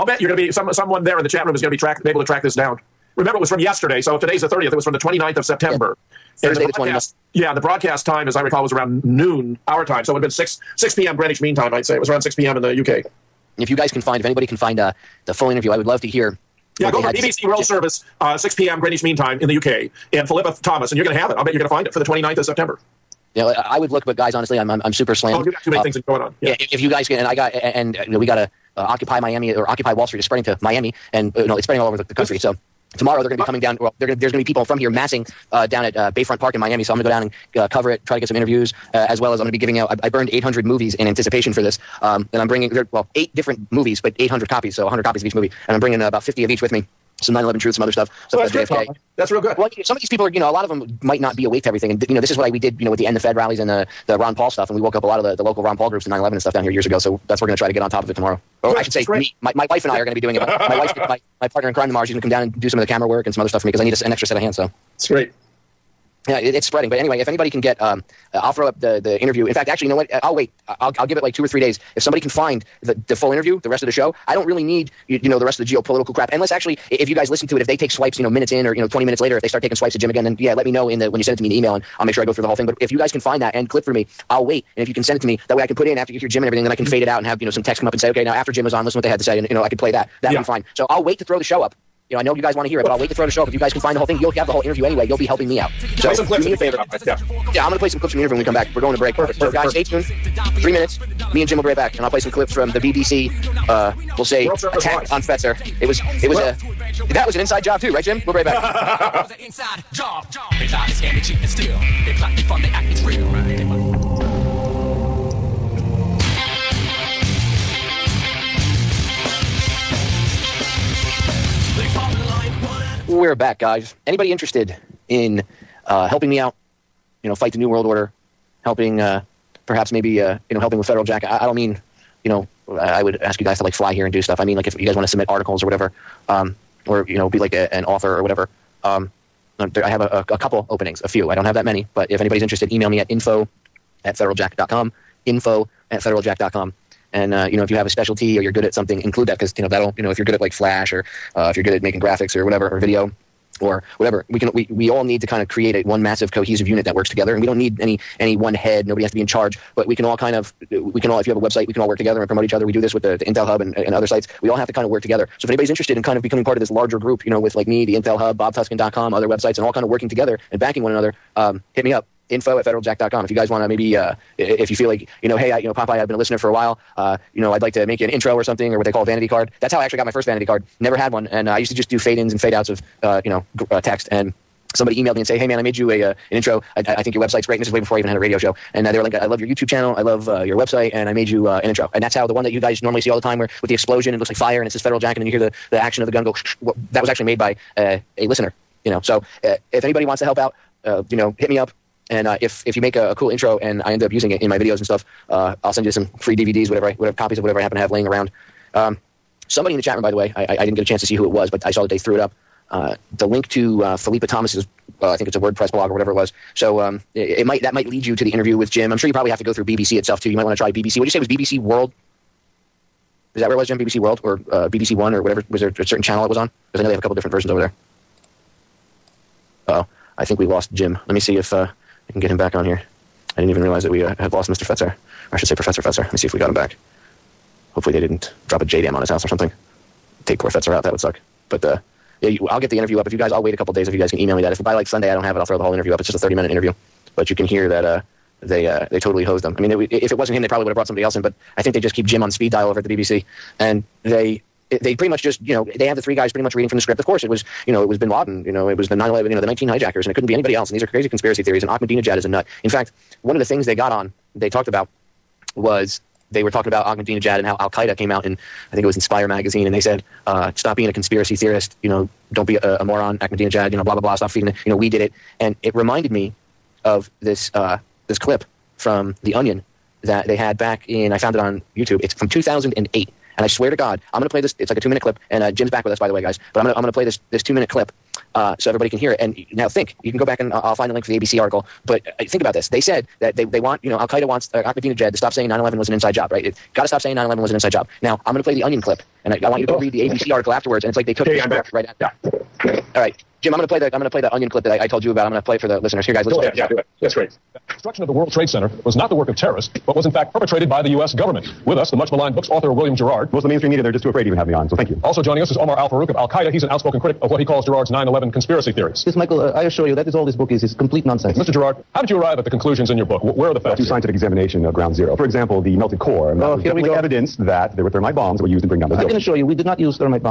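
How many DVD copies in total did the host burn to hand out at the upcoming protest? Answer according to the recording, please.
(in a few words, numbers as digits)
800.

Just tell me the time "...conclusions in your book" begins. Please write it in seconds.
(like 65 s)
322 s.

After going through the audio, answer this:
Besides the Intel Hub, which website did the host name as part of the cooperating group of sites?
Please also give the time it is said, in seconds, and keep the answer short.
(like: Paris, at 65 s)
BobTuskin.com, at 168 s.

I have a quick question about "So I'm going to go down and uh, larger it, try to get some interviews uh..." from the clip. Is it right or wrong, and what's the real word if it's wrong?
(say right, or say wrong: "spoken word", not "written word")
wrong: "cover", not "larger".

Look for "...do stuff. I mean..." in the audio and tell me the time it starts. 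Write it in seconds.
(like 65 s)
134 s.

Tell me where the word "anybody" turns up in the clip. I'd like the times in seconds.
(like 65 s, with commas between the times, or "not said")
14 s, 67 s, 124 s, 142 s, 165 s, 199 s, 260 s.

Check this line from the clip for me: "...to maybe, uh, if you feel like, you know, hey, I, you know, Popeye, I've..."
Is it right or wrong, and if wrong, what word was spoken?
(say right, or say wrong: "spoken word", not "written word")
right.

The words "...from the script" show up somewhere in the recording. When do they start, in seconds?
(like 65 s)
256 s.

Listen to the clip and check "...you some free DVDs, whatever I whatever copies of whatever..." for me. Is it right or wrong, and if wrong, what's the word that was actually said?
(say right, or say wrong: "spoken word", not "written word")
right.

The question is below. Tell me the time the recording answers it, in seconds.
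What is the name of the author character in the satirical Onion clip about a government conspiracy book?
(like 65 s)
312 s.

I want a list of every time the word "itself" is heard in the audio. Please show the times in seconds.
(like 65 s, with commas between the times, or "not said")
219 s.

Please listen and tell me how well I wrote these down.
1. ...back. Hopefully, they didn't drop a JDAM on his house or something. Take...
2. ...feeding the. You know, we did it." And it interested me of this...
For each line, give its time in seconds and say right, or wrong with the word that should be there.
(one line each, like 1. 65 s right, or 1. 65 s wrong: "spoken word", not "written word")
1. 236 s right
2. 274 s wrong: "reminded", not "interested".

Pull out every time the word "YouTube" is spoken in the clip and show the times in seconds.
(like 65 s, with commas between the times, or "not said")
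189 s, 281 s.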